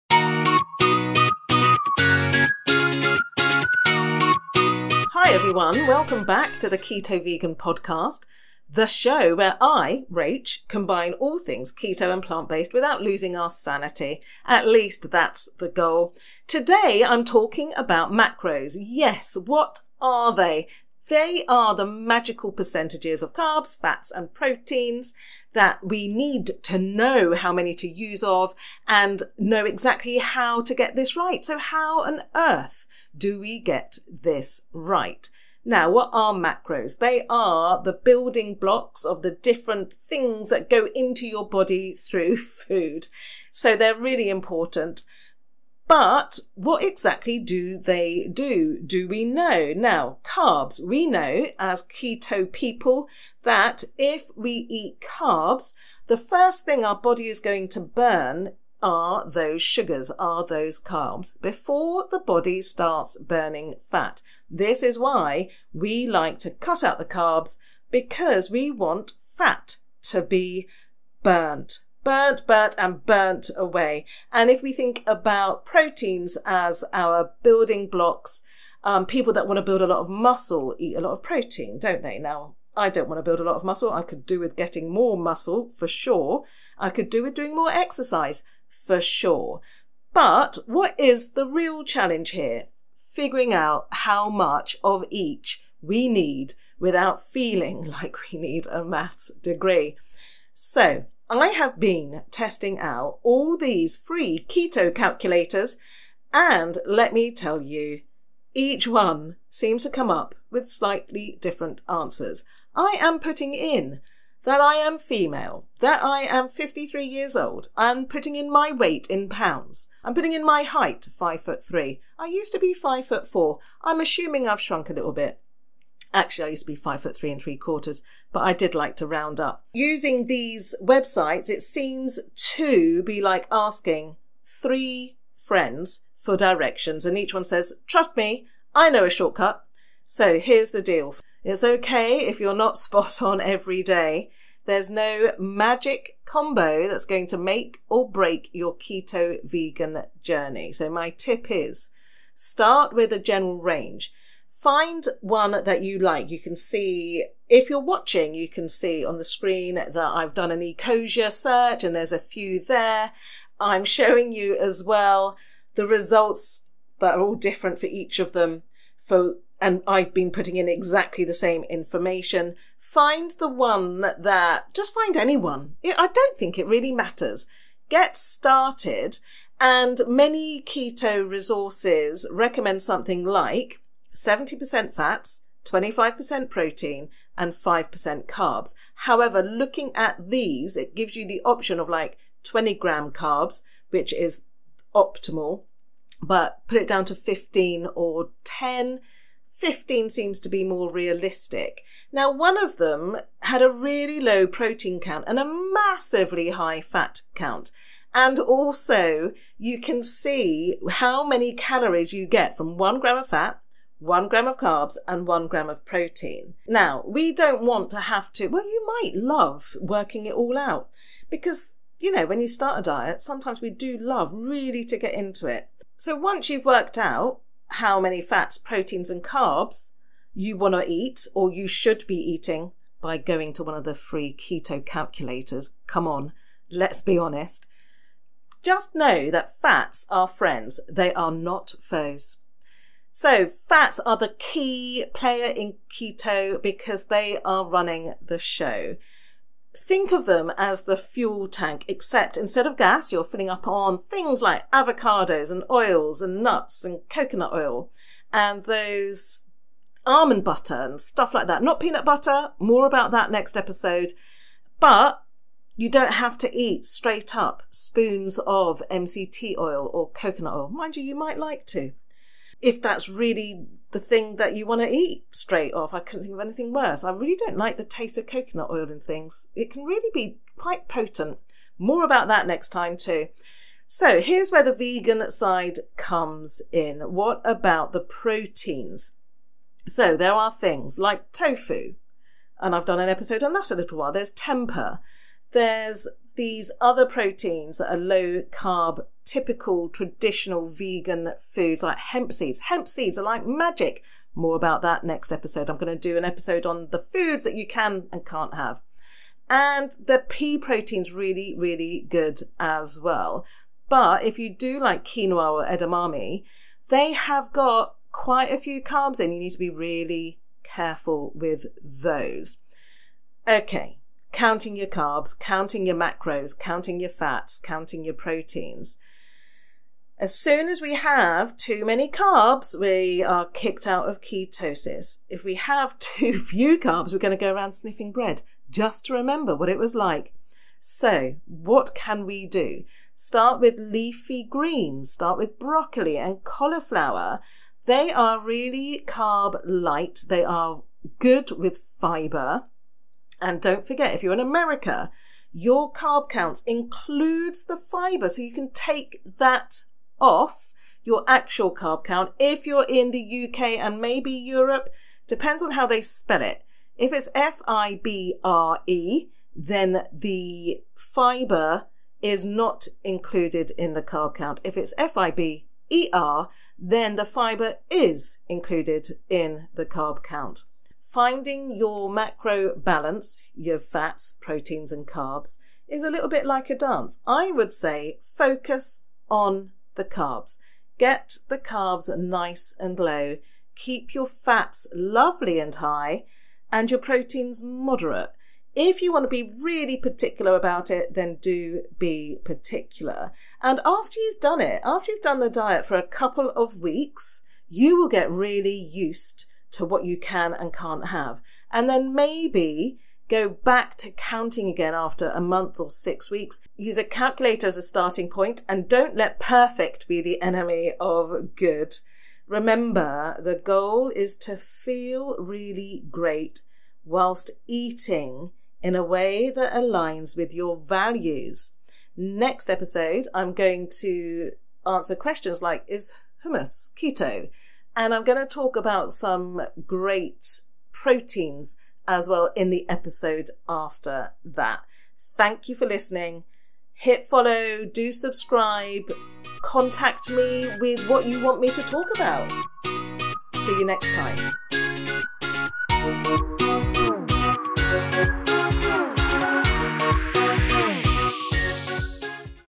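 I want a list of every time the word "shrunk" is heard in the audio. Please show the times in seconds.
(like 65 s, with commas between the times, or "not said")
124 s.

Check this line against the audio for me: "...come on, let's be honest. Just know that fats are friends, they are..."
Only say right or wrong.
right.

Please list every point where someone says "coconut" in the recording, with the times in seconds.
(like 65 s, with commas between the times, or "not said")
257 s, 270 s, 278 s.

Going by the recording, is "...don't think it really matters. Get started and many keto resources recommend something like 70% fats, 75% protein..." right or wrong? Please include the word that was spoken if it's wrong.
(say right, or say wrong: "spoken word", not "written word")
wrong: "25", not "75".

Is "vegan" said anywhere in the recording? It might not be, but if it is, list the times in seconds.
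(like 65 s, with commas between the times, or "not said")
7 s, 149 s, 284 s, 300 s.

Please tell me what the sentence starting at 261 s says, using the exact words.
Not peanut butter, more about that next episode.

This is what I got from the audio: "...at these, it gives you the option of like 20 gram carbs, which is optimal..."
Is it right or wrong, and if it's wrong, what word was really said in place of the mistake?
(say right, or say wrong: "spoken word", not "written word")
right.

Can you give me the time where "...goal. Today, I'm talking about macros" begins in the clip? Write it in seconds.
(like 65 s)
15 s.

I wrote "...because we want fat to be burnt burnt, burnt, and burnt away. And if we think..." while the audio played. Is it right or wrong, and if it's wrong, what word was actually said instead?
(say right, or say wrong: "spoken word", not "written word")
right.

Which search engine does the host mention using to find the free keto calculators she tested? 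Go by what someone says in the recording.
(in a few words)
Ecosia.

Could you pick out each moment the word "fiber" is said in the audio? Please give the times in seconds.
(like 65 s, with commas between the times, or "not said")
351 s, 357 s, 370 s, 377 s.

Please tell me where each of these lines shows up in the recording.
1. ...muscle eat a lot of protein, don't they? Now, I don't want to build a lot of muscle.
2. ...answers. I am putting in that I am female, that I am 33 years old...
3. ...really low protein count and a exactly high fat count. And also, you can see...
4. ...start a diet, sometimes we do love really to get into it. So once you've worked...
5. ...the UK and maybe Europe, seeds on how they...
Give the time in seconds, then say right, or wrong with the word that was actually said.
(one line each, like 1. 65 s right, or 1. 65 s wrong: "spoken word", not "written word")
1. 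80 s right
2. 111 s wrong: "53", not "33"
3. 203 s wrong: "massively", not "exactly"
4. 222 s right
5. 363 s wrong: "depends", not "seeds".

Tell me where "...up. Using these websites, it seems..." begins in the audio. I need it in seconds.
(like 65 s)
129 s.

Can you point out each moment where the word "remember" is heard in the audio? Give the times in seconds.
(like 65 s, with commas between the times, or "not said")
339 s, 422 s.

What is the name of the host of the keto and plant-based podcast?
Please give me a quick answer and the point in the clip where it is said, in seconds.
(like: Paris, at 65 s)
Rach, at 10 s.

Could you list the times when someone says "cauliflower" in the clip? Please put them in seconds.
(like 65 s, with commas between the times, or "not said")
346 s.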